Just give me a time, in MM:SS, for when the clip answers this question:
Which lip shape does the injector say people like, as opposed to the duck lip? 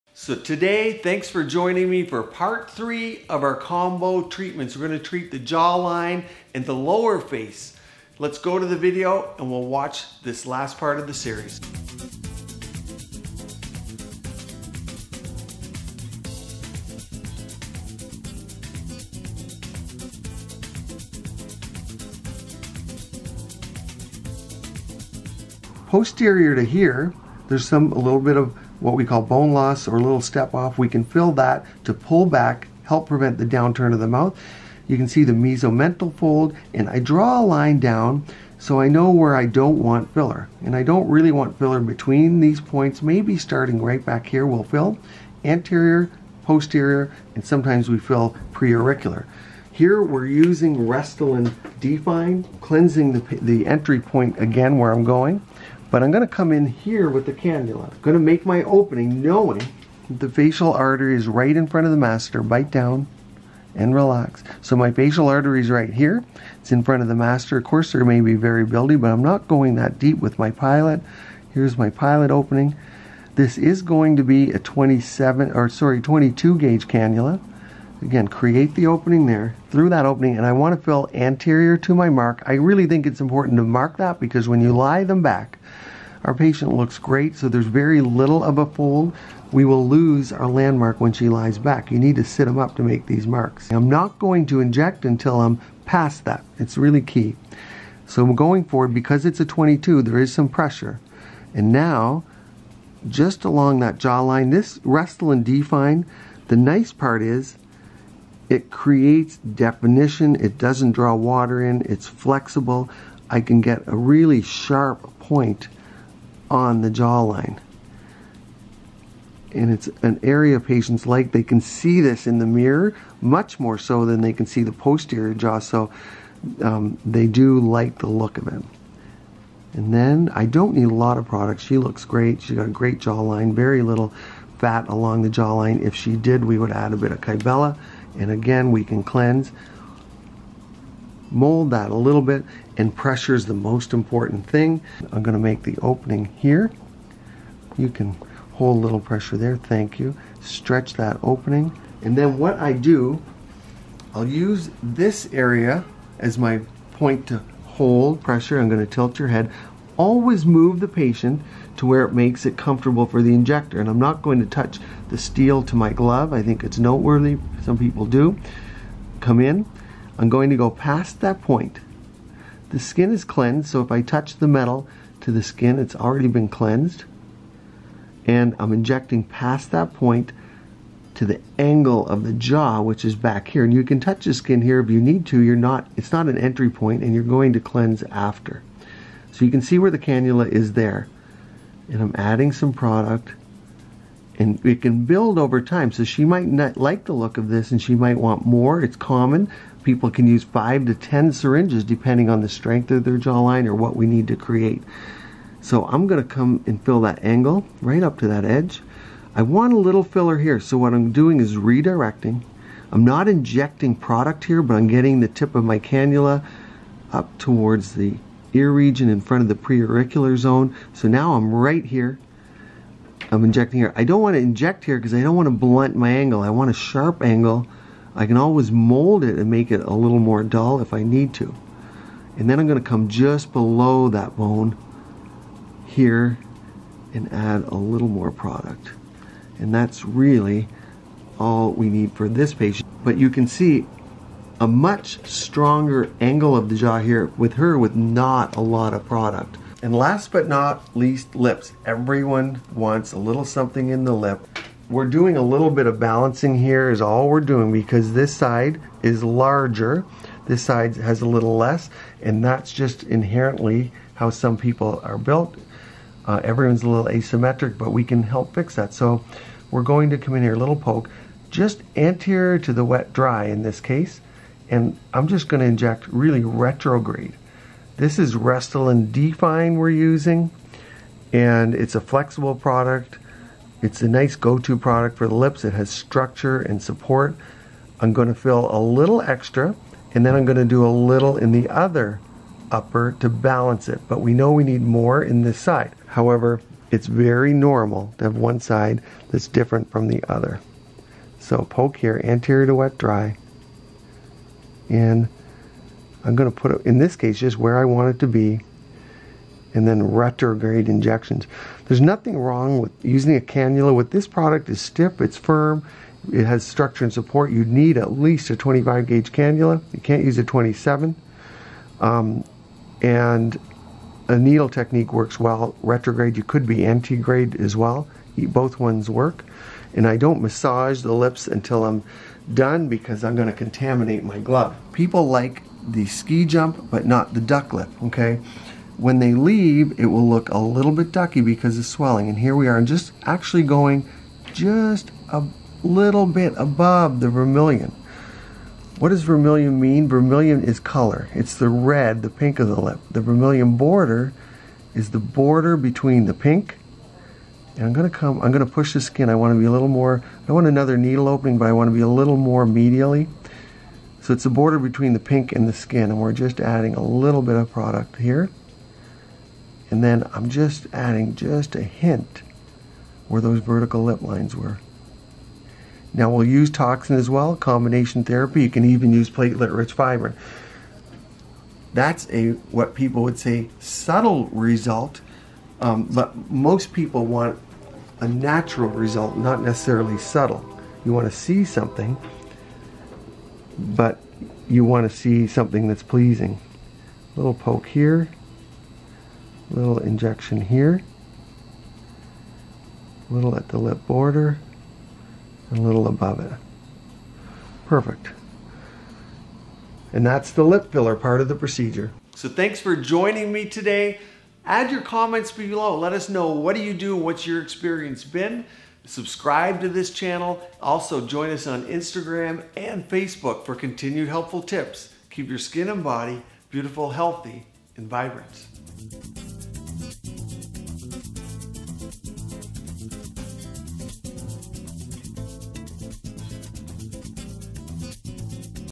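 05:36.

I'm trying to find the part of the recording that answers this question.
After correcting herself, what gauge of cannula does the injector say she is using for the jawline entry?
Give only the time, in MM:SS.
01:15.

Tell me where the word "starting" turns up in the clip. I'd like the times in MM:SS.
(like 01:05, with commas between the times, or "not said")
00:43.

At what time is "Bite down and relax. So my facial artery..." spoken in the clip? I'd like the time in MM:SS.
01:02.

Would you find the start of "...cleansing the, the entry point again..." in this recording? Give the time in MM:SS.
00:52.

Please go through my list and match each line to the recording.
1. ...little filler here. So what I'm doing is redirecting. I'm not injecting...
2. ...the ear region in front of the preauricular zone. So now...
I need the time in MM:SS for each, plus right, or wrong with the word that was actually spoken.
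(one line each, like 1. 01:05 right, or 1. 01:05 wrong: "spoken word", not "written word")
1. 03:29 right
2. 03:37 right.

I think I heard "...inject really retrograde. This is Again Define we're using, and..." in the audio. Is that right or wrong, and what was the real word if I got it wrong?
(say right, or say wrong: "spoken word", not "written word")
wrong: "Restylane", not "Again".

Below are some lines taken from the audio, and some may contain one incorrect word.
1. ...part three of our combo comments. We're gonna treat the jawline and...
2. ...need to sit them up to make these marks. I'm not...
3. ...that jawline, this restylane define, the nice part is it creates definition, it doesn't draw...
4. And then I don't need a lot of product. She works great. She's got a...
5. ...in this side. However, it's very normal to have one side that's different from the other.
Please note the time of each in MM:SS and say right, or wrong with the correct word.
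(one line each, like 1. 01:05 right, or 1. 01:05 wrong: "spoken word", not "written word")
1. 00:02 wrong: "treatments", not "comments"
2. 01:31 right
3. 01:43 right
4. 02:09 wrong: "looks", not "works"
5. 04:55 right.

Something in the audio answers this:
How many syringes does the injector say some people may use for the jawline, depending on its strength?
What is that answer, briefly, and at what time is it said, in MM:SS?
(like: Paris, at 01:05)
5 to 10, at 03:20.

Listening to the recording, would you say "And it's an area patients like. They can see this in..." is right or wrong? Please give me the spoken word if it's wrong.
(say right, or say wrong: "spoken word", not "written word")
right.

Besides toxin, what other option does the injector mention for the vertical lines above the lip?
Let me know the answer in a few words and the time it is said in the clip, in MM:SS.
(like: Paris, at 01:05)
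platelet-rich fibrin, at 06:19.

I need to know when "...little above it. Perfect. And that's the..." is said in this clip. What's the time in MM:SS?
06:45.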